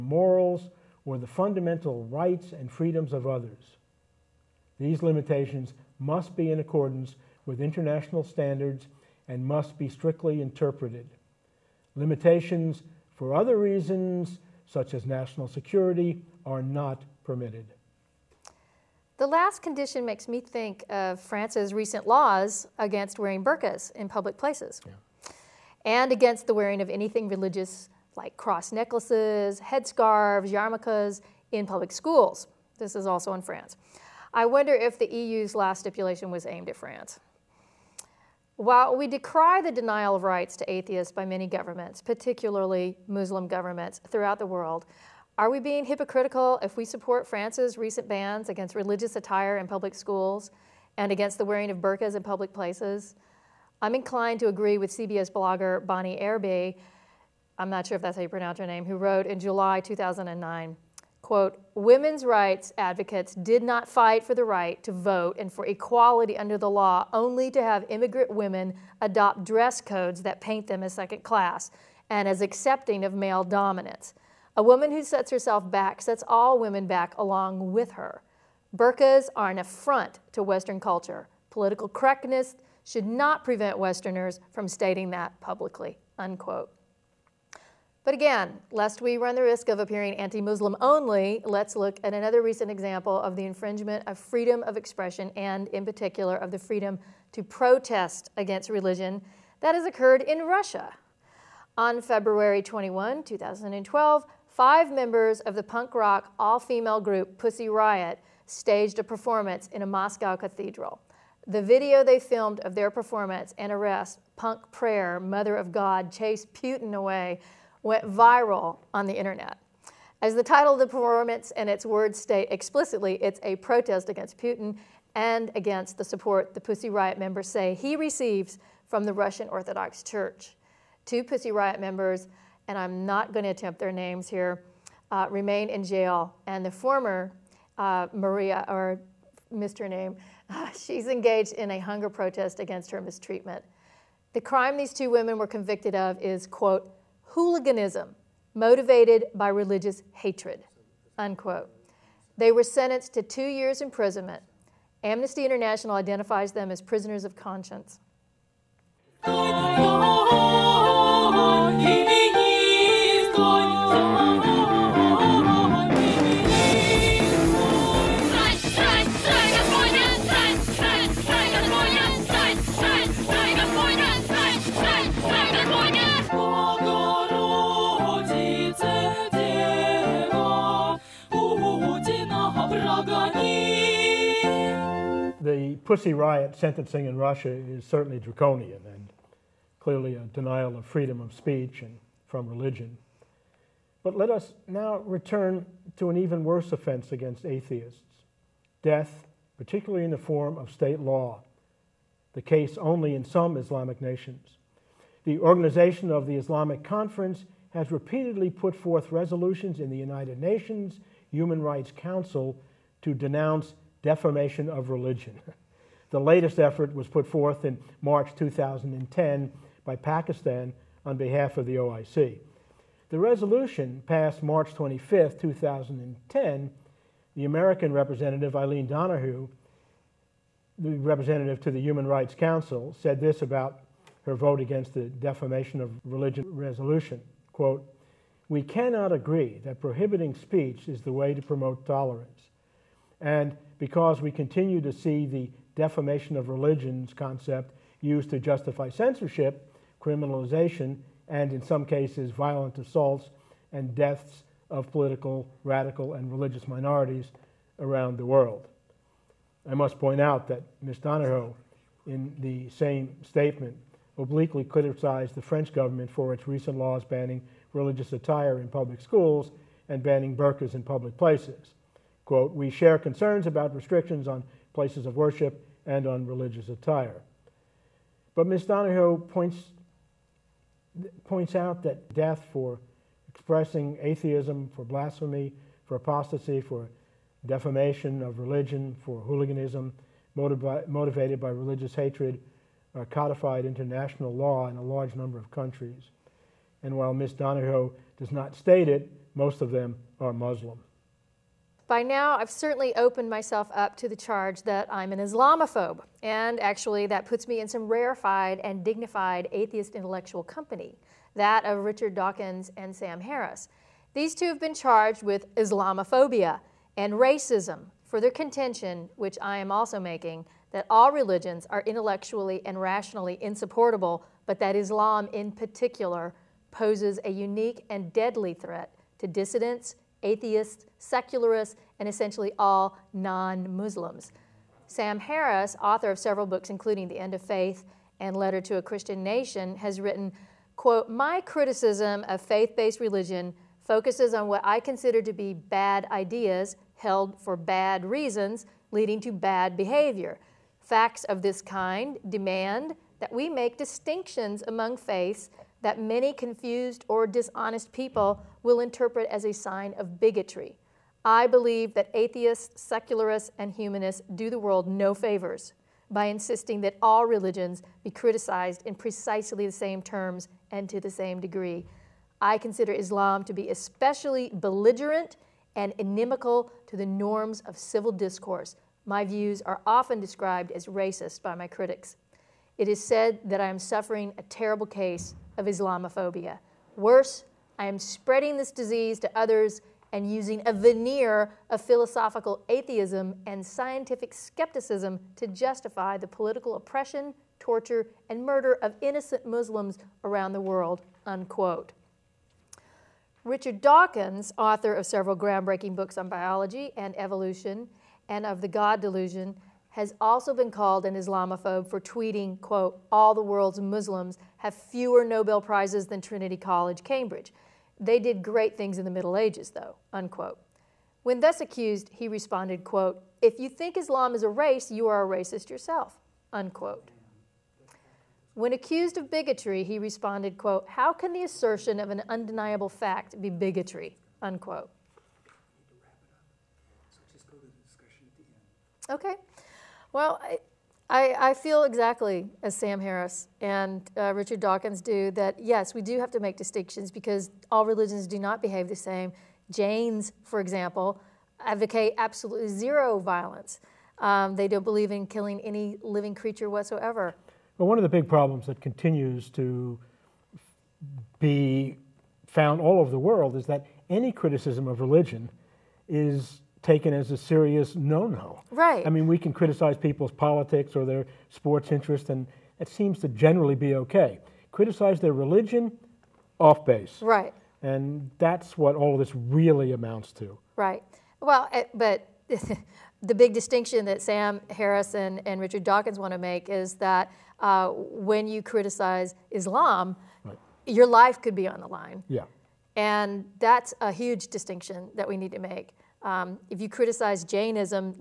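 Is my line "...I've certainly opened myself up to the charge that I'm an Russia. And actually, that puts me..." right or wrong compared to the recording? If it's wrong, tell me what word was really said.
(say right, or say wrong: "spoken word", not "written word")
wrong: "Islamophobe", not "Russia".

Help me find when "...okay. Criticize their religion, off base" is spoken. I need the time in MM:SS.
07:53.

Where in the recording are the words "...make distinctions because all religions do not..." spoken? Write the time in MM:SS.
07:26.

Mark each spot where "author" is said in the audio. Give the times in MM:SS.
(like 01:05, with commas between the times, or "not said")
05:35, 06:44.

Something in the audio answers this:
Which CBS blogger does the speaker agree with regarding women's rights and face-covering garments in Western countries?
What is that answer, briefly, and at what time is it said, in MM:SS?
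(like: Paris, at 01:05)
Bonnie Erbe, at 00:55.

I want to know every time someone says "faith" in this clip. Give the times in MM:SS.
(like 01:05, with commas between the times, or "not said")
05:37, 05:42, 05:54.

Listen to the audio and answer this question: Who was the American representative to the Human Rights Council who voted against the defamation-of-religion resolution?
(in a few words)
Eileen Donahoe.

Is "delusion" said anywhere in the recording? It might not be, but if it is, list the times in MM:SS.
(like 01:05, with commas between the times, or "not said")
06:48.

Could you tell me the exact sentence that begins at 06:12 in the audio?
I consider Islam to be especially belligerent and inimical to the norms of civil discourse.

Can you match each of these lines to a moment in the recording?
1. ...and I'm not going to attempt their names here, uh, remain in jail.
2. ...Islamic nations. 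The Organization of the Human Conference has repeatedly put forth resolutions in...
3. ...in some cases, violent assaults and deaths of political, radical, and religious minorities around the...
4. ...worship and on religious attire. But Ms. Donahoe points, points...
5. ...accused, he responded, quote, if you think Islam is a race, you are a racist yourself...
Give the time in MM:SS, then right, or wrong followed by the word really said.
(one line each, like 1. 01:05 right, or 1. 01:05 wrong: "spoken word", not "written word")
1. 02:12 right
2. 03:23 wrong: "Islamic", not "Human"
3. 04:11 right
4. 04:35 right
5. 07:01 right.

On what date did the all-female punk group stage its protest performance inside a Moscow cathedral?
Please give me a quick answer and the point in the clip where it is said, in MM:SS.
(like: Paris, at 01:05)
February 21, 2012, at 01:42.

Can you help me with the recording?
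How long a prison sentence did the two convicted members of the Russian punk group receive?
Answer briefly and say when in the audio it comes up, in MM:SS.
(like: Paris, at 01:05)
2 years, at 02:33.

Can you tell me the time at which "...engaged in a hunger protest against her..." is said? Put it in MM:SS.
02:21.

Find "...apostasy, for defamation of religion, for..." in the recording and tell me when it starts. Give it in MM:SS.
04:45.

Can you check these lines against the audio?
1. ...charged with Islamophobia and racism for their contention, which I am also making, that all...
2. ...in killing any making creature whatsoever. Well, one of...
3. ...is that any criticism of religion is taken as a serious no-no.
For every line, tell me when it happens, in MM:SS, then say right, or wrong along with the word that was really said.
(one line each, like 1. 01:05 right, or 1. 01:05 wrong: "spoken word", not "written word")
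1. 05:14 right
2. 07:35 wrong: "living", not "making"
3. 07:43 right.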